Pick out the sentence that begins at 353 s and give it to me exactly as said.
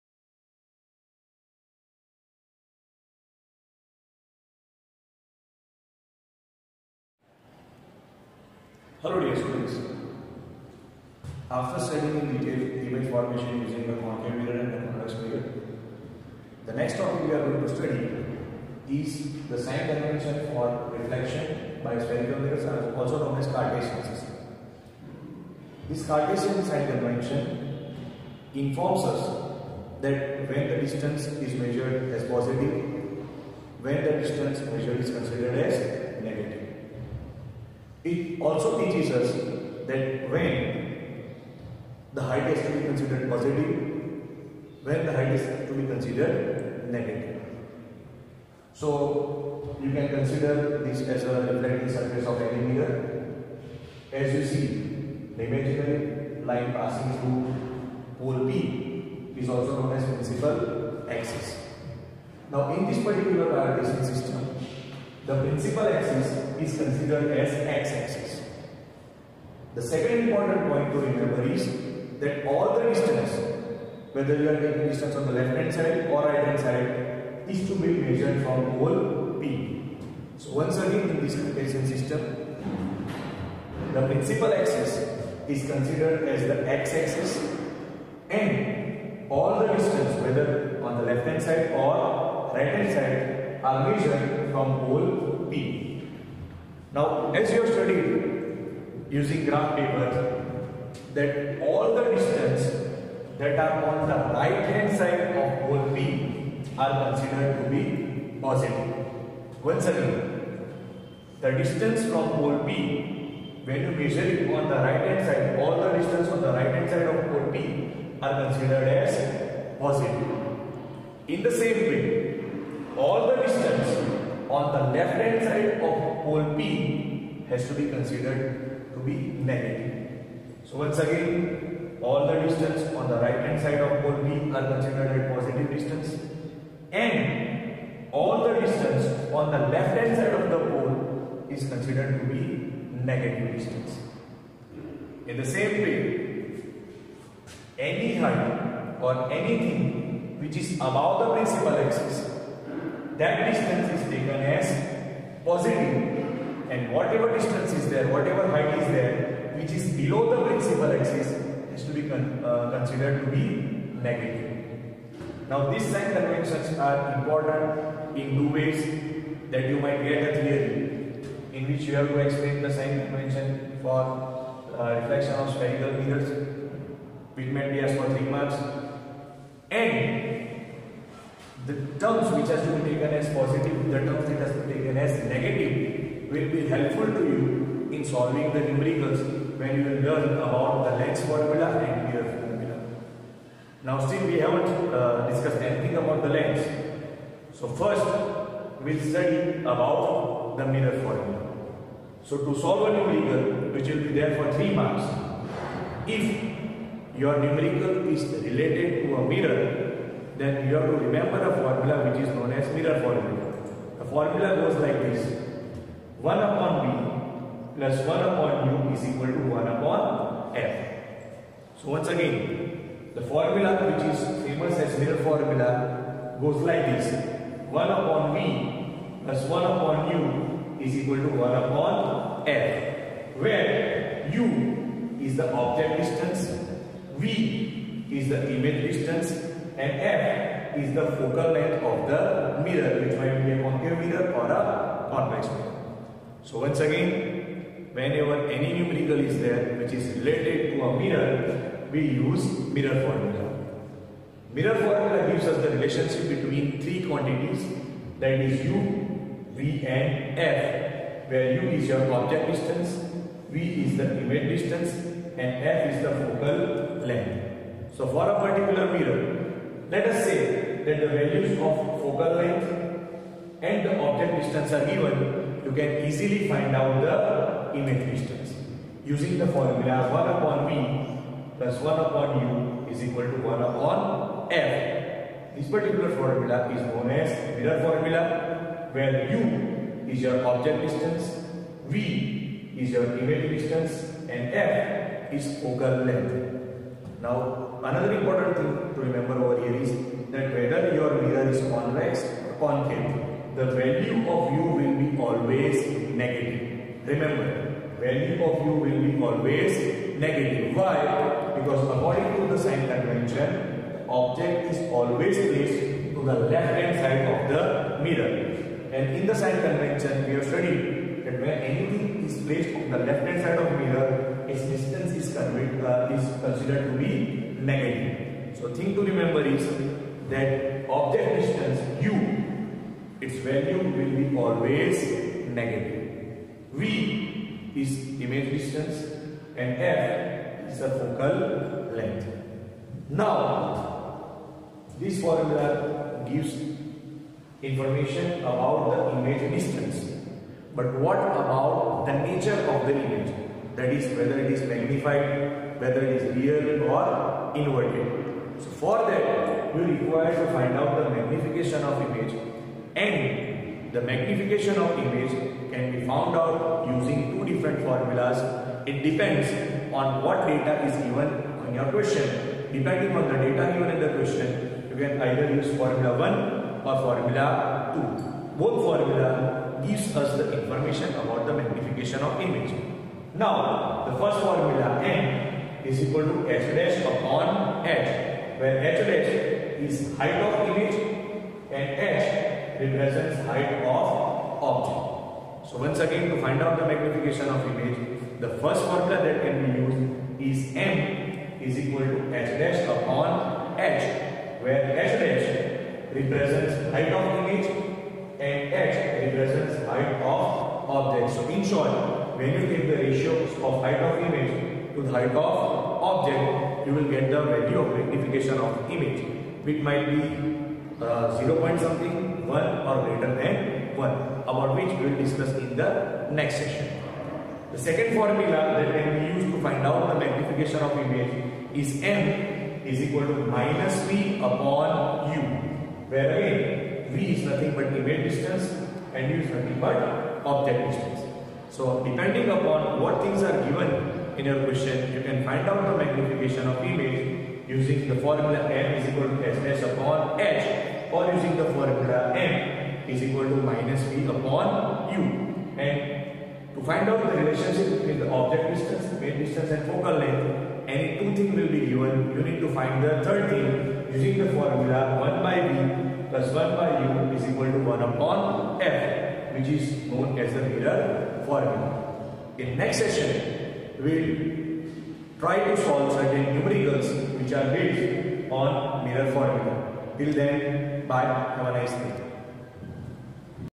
That is whether it is magnified, whether it is real or inverted.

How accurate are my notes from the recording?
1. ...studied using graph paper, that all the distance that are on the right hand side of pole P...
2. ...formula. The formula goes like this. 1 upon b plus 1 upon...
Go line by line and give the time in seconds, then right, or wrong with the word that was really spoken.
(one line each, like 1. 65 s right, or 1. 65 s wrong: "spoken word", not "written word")
1. 97 s right
2. 213 s right.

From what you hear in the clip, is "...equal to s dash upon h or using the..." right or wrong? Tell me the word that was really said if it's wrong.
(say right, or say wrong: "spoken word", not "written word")
right.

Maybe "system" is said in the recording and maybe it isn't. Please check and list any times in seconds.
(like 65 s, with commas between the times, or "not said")
24 s, 64 s, 81 s.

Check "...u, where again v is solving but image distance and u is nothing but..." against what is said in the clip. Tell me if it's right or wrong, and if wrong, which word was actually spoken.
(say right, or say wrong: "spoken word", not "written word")
wrong: "nothing", not "solving".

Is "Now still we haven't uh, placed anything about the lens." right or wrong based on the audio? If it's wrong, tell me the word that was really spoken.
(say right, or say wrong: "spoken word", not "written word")
wrong: "discussed", not "placed".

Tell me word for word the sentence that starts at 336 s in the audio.
V is image distance and F is the focal length.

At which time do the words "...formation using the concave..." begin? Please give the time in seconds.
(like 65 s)
13 s.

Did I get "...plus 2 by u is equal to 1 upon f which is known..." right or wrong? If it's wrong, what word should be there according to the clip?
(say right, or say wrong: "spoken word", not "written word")
wrong: "1", not "2".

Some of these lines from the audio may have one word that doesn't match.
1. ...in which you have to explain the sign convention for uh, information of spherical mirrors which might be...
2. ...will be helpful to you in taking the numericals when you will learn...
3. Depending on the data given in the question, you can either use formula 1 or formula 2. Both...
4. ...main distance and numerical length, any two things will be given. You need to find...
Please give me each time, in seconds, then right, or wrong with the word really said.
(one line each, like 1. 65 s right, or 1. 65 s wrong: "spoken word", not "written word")
1. 171 s wrong: "reflection", not "information"
2. 186 s wrong: "solving", not "taking"
3. 372 s right
4. 459 s wrong: "focal", not "numerical".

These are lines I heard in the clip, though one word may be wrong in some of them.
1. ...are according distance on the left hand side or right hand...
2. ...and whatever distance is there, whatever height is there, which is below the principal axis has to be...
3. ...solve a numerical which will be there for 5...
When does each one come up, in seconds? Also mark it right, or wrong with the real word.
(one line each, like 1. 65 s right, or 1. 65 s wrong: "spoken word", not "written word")
1. 74 s wrong: "taking", not "according"
2. 156 s right
3. 202 s wrong: "3", not "5".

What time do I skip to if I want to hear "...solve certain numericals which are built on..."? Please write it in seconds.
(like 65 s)
475 s.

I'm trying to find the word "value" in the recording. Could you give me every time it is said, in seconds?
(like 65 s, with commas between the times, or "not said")
271 s, 303 s, 307 s, 333 s, 417 s.